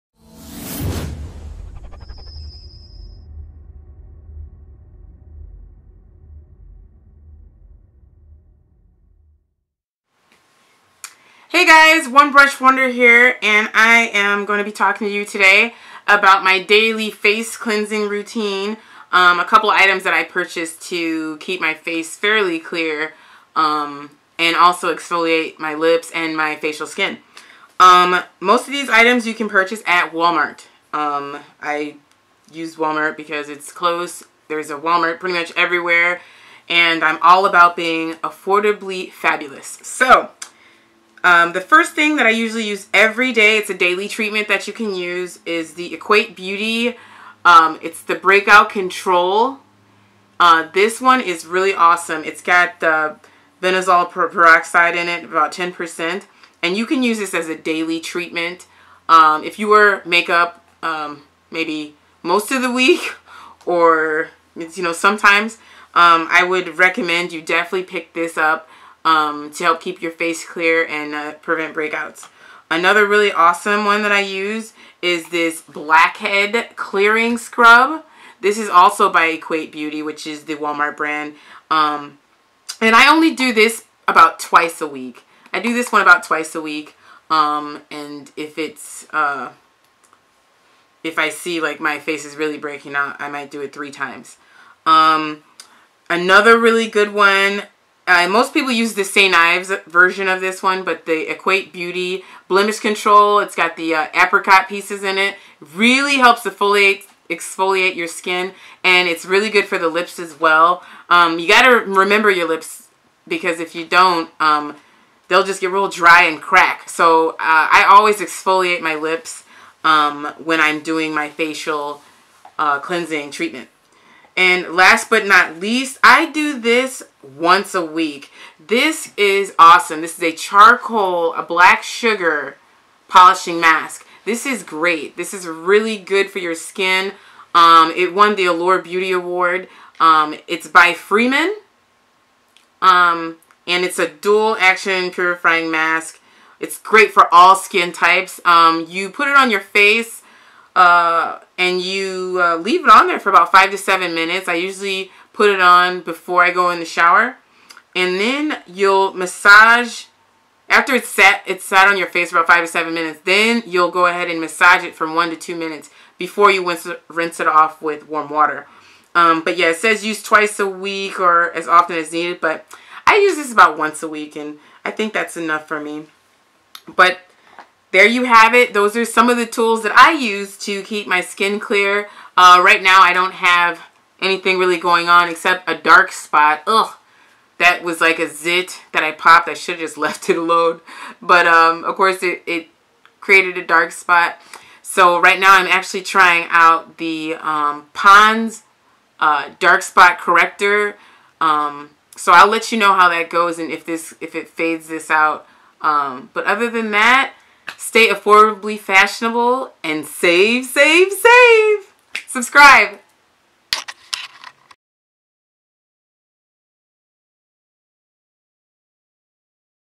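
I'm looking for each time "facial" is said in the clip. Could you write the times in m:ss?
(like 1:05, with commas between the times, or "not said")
0:26, 2:01.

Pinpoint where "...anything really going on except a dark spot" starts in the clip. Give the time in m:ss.
3:04.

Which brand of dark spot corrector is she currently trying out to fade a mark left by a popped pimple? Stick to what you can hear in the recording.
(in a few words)
Pond's.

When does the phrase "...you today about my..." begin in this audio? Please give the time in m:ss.
0:15.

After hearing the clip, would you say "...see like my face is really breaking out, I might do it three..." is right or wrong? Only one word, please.
right.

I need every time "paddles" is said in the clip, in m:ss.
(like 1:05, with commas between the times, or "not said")
not said.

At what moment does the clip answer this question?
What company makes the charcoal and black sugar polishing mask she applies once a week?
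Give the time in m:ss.
2:20.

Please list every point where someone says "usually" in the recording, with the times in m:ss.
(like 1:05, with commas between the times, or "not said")
0:42, 2:34.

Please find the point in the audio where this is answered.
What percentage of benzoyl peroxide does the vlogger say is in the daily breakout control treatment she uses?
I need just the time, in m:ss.
0:55.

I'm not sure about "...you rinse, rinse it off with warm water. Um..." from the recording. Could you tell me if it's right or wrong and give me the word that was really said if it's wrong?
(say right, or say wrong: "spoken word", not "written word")
right.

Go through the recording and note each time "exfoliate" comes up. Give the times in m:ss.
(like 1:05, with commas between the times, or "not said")
0:24, 1:47, 1:58.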